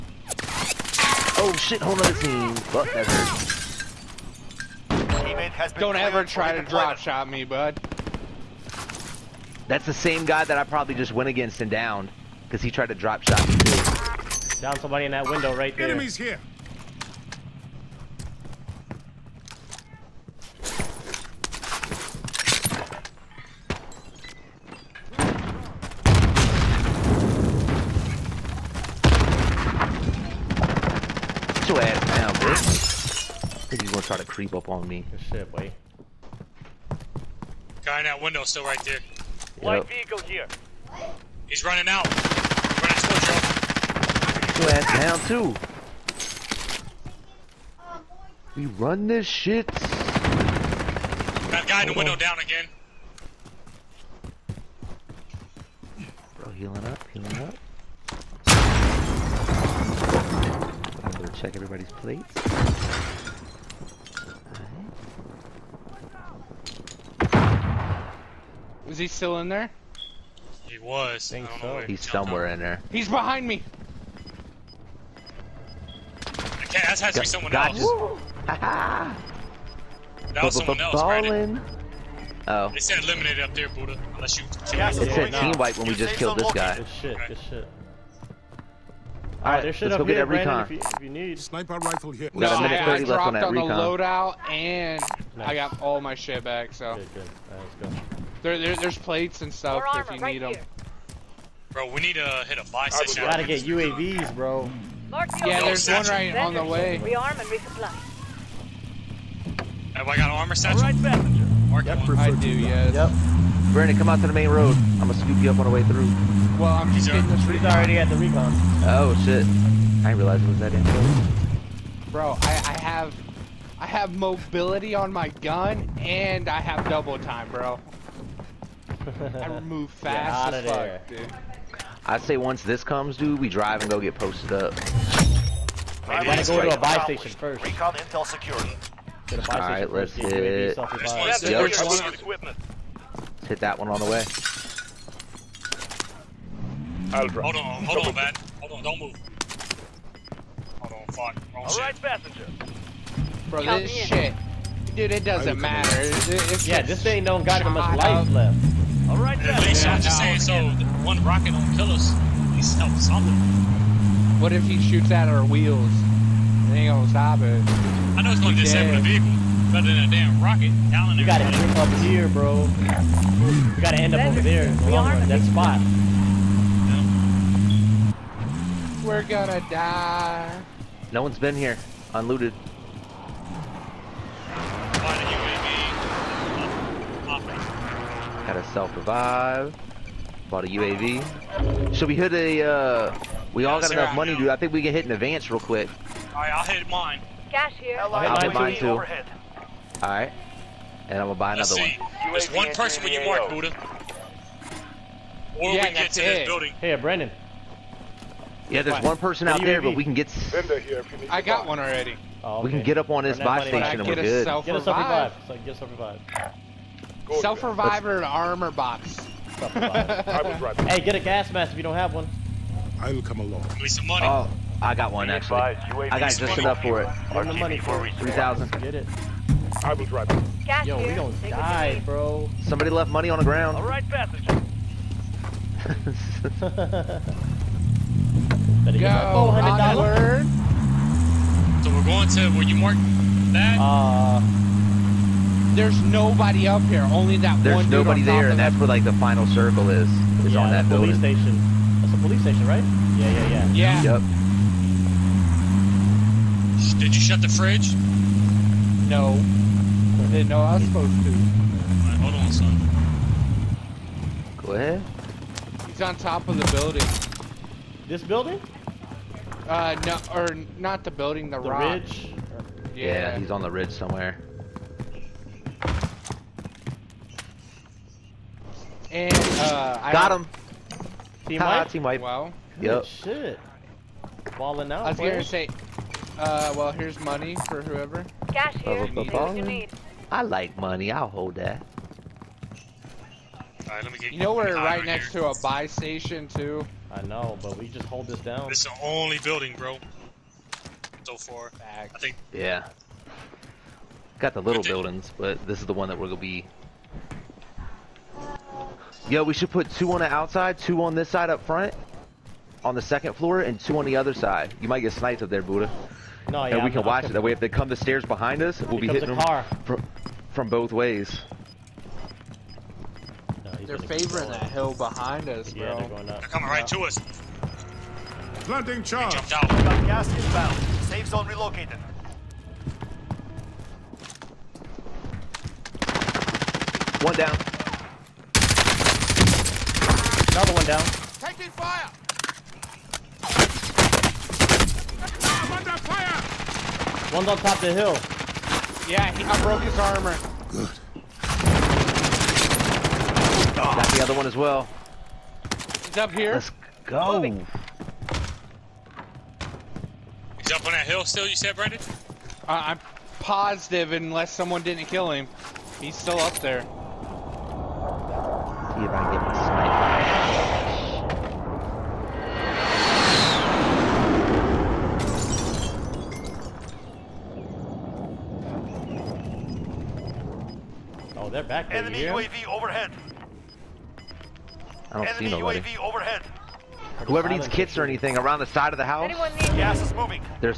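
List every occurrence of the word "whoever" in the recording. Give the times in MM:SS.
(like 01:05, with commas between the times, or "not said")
04:47, 06:27.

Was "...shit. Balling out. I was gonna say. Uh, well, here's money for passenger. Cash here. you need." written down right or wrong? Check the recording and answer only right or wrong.
wrong.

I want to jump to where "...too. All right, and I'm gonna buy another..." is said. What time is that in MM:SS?
03:18.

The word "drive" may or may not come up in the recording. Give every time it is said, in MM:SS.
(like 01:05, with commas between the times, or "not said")
02:13, 03:50.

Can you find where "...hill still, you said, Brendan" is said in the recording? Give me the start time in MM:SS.
06:01.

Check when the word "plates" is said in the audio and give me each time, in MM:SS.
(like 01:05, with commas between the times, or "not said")
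01:01, 01:38.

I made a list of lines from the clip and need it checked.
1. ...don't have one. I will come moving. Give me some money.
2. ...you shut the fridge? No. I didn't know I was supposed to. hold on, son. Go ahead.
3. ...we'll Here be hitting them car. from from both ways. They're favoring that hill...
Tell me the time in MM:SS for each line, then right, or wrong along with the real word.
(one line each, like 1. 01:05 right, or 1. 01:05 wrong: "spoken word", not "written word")
1. 03:41 wrong: "along", not "moving"
2. 04:17 right
3. 05:18 right.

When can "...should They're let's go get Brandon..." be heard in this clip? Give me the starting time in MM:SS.
01:29.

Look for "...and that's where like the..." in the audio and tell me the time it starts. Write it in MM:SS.
04:08.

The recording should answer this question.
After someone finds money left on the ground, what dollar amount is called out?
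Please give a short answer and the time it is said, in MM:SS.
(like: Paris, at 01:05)
$400, at 03:59.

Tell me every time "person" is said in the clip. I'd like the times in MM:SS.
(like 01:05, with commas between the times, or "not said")
03:22, 03:29.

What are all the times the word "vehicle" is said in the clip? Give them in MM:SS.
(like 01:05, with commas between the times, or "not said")
00:39, 02:49.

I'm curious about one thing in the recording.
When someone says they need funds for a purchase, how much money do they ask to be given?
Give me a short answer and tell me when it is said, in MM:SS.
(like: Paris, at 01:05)
3000, at 03:48.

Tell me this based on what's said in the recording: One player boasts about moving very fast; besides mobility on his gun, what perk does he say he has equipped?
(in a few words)
Double time.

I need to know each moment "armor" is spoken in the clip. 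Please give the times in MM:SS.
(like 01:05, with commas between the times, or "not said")
01:50, 03:37, 05:49.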